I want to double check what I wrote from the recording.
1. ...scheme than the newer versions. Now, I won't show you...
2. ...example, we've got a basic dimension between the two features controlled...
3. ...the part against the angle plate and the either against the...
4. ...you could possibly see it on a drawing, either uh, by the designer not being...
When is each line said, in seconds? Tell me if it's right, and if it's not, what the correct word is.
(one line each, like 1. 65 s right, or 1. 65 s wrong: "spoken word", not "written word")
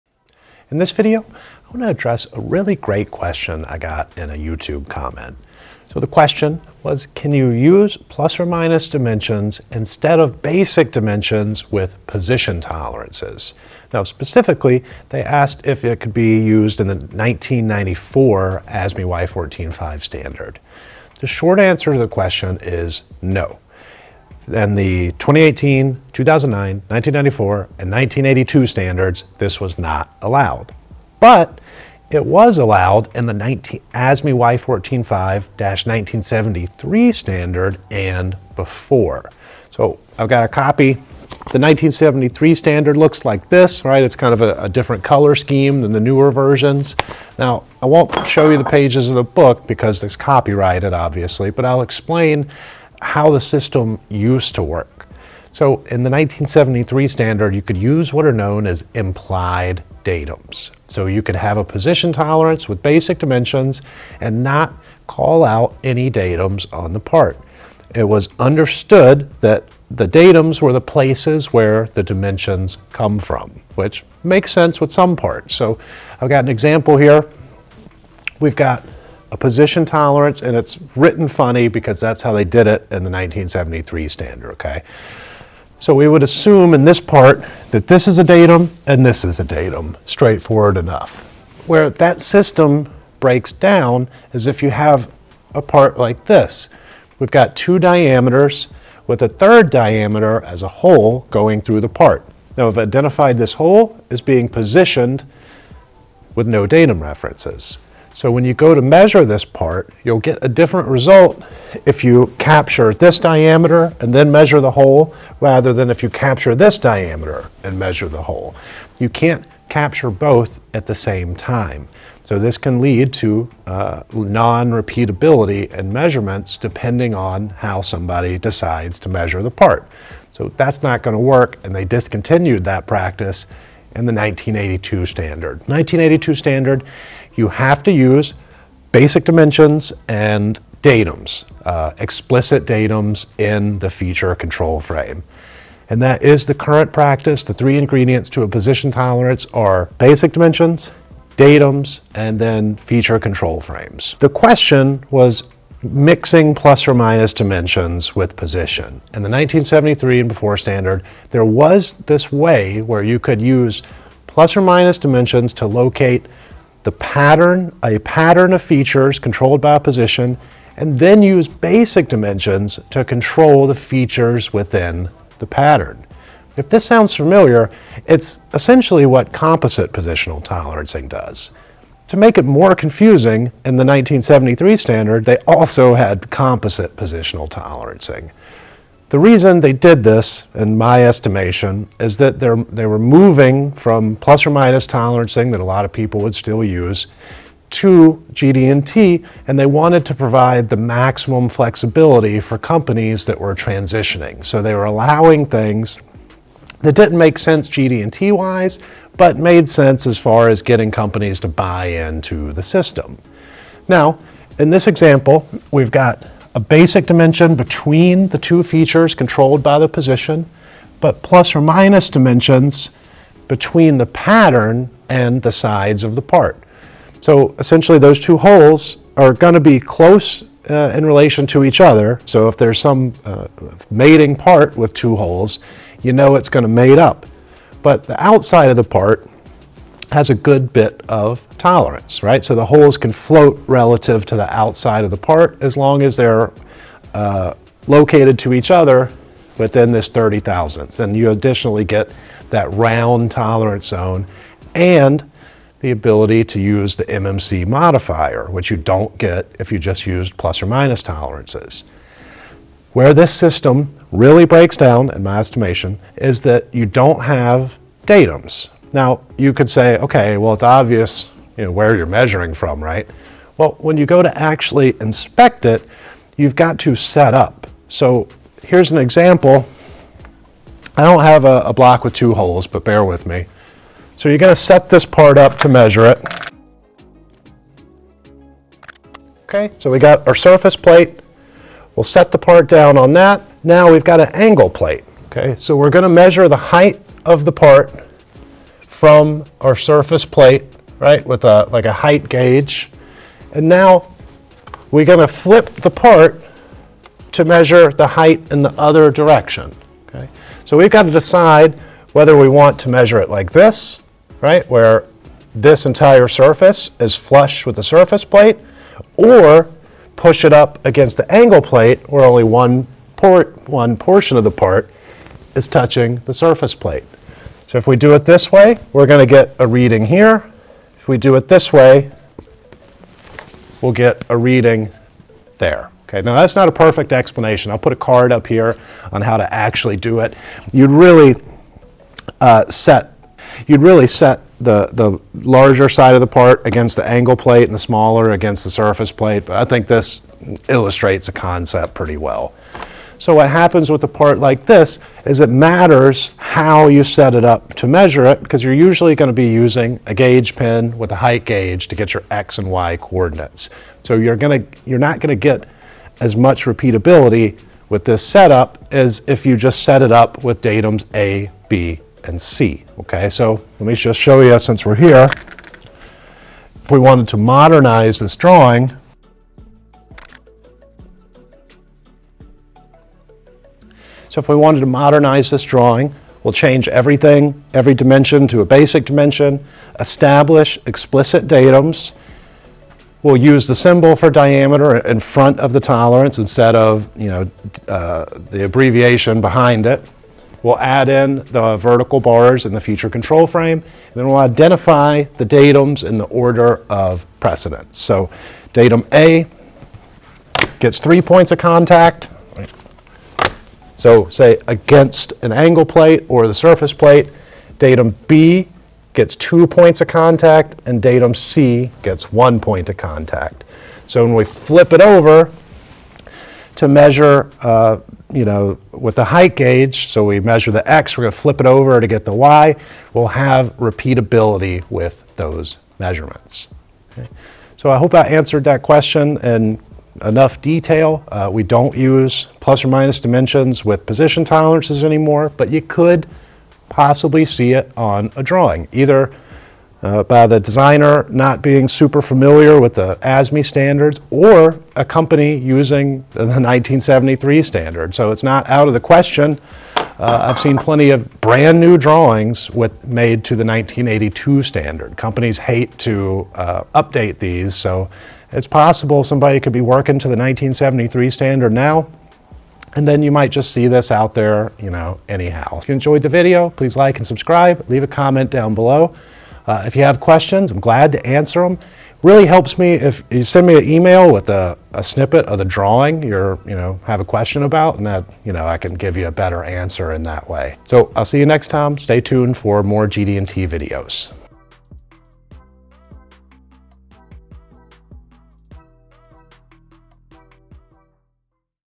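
1. 45 s right
2. 214 s right
3. 346 s wrong: "smaller", not "either"
4. 445 s right.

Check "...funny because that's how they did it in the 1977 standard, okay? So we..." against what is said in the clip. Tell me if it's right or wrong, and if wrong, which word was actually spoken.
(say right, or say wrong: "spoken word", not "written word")
wrong: "1973", not "1977".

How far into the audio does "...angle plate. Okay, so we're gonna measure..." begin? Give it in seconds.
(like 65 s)
294 s.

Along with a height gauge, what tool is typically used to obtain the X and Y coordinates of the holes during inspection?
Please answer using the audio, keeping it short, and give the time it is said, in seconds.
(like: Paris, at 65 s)
gauge pin, at 360 s.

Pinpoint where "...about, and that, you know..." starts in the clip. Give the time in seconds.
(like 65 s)
487 s.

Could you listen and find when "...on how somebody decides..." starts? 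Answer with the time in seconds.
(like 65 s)
127 s.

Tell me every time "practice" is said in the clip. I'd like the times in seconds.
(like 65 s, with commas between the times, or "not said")
132 s, 146 s.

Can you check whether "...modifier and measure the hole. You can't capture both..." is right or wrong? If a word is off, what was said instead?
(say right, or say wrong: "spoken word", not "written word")
wrong: "diameter", not "modifier".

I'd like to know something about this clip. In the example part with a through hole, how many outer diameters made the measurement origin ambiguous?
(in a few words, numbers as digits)
2.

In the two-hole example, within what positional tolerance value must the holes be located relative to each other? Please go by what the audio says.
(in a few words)
30 thousandths.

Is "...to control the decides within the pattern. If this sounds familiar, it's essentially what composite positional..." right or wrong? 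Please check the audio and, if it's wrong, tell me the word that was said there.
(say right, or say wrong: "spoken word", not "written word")
wrong: "features", not "decides".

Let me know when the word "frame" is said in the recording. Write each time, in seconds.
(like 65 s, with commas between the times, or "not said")
144 s, 153 s, 403 s.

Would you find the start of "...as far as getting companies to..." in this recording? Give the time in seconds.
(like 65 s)
210 s.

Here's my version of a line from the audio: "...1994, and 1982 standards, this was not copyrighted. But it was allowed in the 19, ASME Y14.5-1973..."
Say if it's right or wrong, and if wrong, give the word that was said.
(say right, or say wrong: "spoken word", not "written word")
wrong: "allowed", not "copyrighted".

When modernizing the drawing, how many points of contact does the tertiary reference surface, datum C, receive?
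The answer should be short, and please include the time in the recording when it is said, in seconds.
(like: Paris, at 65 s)
1, at 422 s.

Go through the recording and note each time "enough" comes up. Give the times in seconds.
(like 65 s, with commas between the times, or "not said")
90 s, 440 s.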